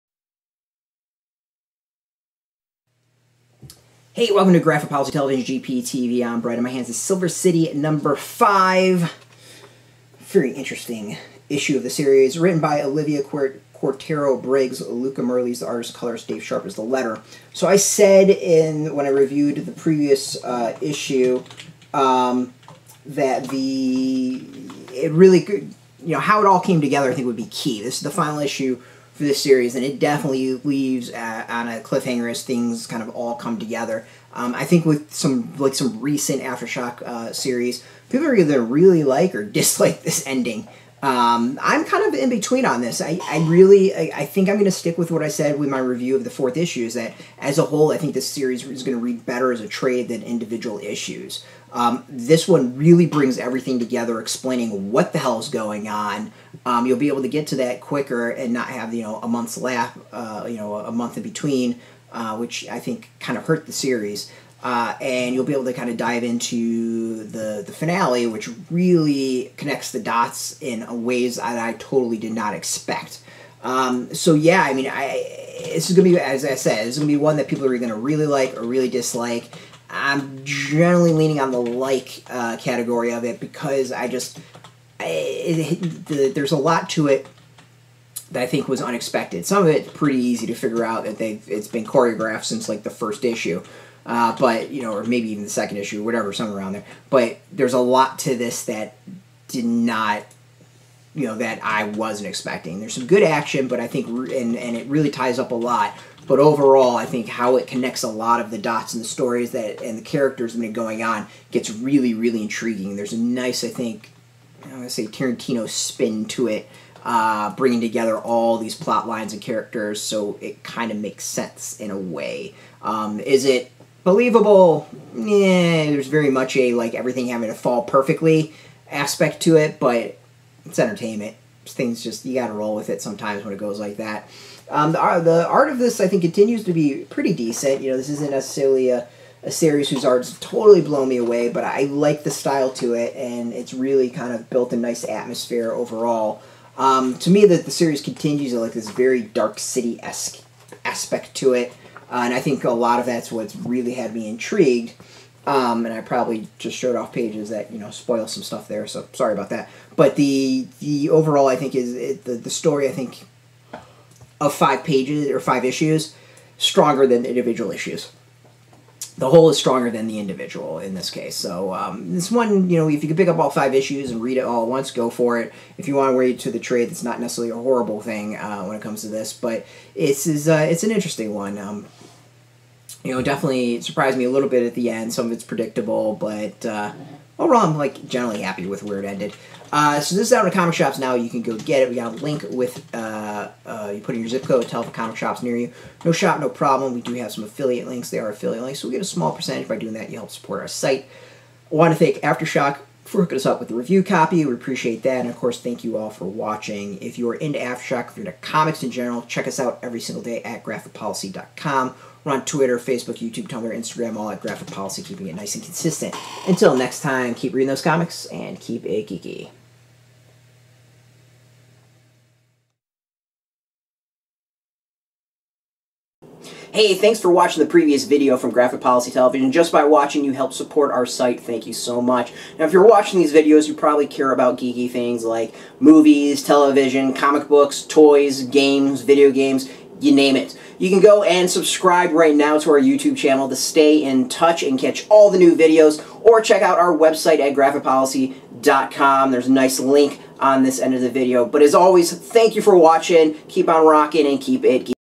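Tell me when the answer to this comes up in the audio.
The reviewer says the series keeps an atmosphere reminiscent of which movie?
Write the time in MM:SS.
02:29.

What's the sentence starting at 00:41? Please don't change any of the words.
Um, I'm kind of in between on this.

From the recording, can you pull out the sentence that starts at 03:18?
They are affiliate links, so we get a small percentage by doing that.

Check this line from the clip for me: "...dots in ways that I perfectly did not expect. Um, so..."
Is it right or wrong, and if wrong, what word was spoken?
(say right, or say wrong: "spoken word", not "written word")
wrong: "totally", not "perfectly".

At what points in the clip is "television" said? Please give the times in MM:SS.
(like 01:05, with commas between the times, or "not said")
00:05, 03:49, 03:56.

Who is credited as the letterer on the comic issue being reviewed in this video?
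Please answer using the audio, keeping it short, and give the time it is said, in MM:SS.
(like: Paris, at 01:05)
Dave Sharpe, at 00:16.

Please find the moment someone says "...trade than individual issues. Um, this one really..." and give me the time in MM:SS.
00:49.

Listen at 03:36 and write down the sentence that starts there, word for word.
Until next time, keep reading those comics and keep it geeky.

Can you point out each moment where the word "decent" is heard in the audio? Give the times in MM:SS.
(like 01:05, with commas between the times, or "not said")
02:17.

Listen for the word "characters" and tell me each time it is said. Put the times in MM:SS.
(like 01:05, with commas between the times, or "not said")
01:50, 01:59.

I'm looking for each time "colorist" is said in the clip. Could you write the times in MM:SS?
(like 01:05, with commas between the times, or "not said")
00:15.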